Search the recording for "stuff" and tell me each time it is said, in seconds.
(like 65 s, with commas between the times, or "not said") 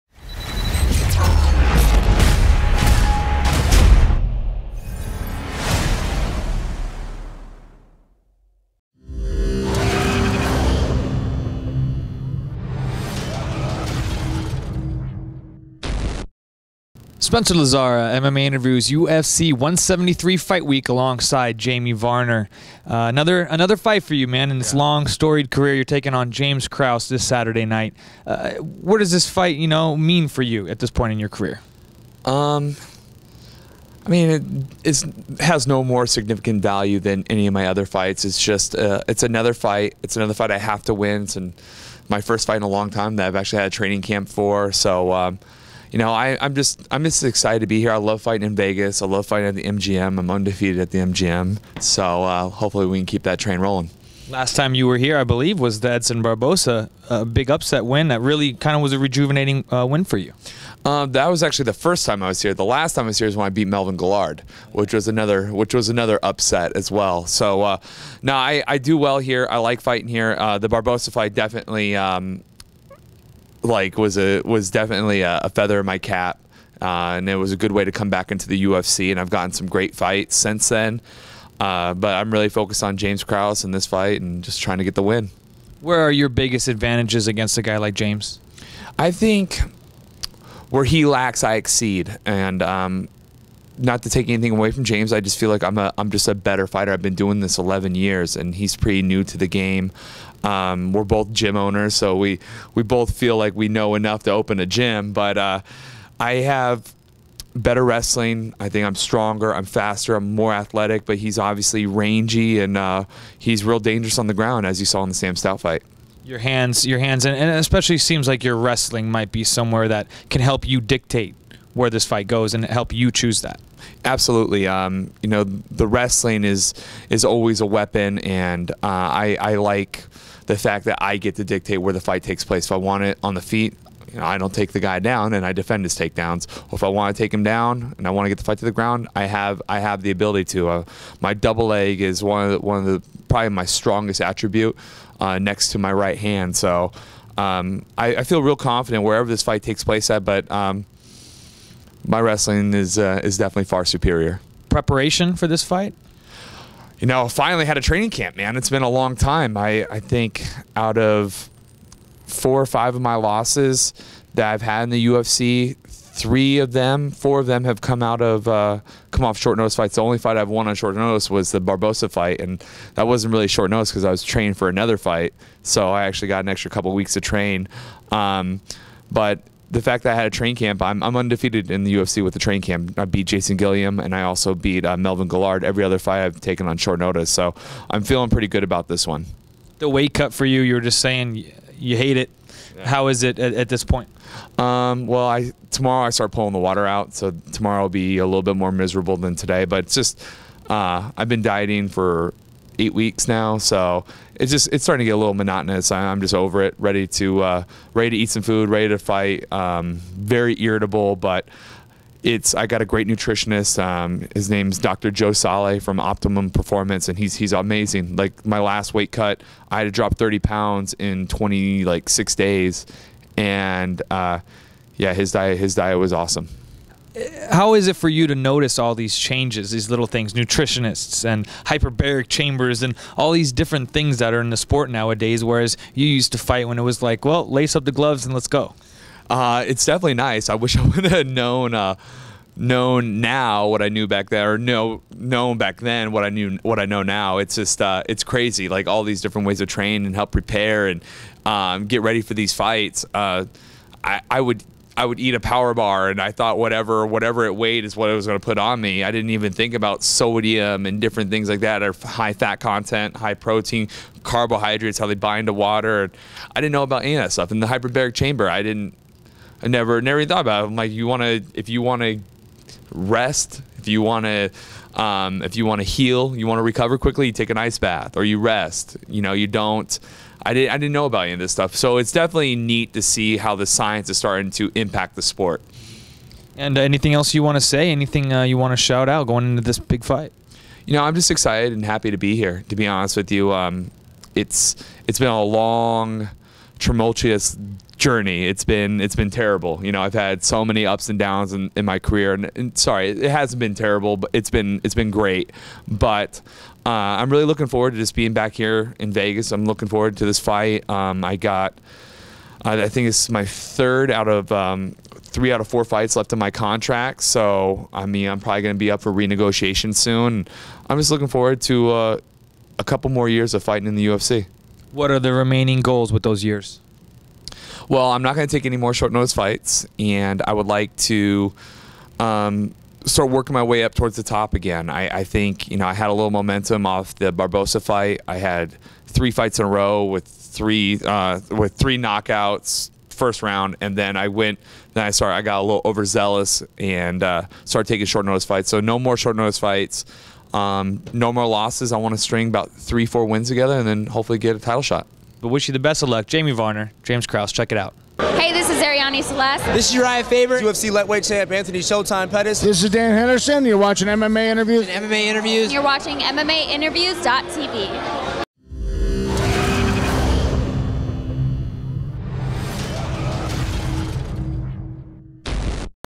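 267 s, 281 s.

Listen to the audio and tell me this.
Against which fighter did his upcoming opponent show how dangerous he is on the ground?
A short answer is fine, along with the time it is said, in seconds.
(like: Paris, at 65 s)
Sam Stout, at 115 s.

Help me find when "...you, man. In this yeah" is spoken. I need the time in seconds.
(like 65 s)
24 s.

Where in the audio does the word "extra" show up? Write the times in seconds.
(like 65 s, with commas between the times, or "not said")
176 s.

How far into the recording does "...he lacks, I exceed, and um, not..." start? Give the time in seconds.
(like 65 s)
90 s.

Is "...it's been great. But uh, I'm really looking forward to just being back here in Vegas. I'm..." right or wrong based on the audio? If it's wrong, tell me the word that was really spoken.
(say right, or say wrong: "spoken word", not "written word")
right.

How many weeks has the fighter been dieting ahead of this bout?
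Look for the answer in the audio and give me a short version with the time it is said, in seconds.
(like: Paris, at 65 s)
8, at 202 s.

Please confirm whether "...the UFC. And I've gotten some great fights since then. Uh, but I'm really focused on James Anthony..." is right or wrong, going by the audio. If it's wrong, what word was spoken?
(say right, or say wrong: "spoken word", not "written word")
wrong: "Krause", not "Anthony".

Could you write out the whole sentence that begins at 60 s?
Uh, that was actually the first time I was here.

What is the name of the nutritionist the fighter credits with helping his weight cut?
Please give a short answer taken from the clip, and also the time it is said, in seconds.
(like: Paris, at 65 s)
Dr. Joe Sale, at 214 s.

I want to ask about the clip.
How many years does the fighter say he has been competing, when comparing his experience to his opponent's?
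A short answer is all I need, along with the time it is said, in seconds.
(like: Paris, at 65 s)
11, at 97 s.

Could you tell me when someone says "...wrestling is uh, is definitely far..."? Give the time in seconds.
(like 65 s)
152 s.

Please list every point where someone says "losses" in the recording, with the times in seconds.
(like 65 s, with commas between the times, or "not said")
163 s, 351 s.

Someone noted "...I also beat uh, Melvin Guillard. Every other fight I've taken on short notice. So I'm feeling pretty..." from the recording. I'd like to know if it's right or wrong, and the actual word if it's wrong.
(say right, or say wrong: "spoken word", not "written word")
right.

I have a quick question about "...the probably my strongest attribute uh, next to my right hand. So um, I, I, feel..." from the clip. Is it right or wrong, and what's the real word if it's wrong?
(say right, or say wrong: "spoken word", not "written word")
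right.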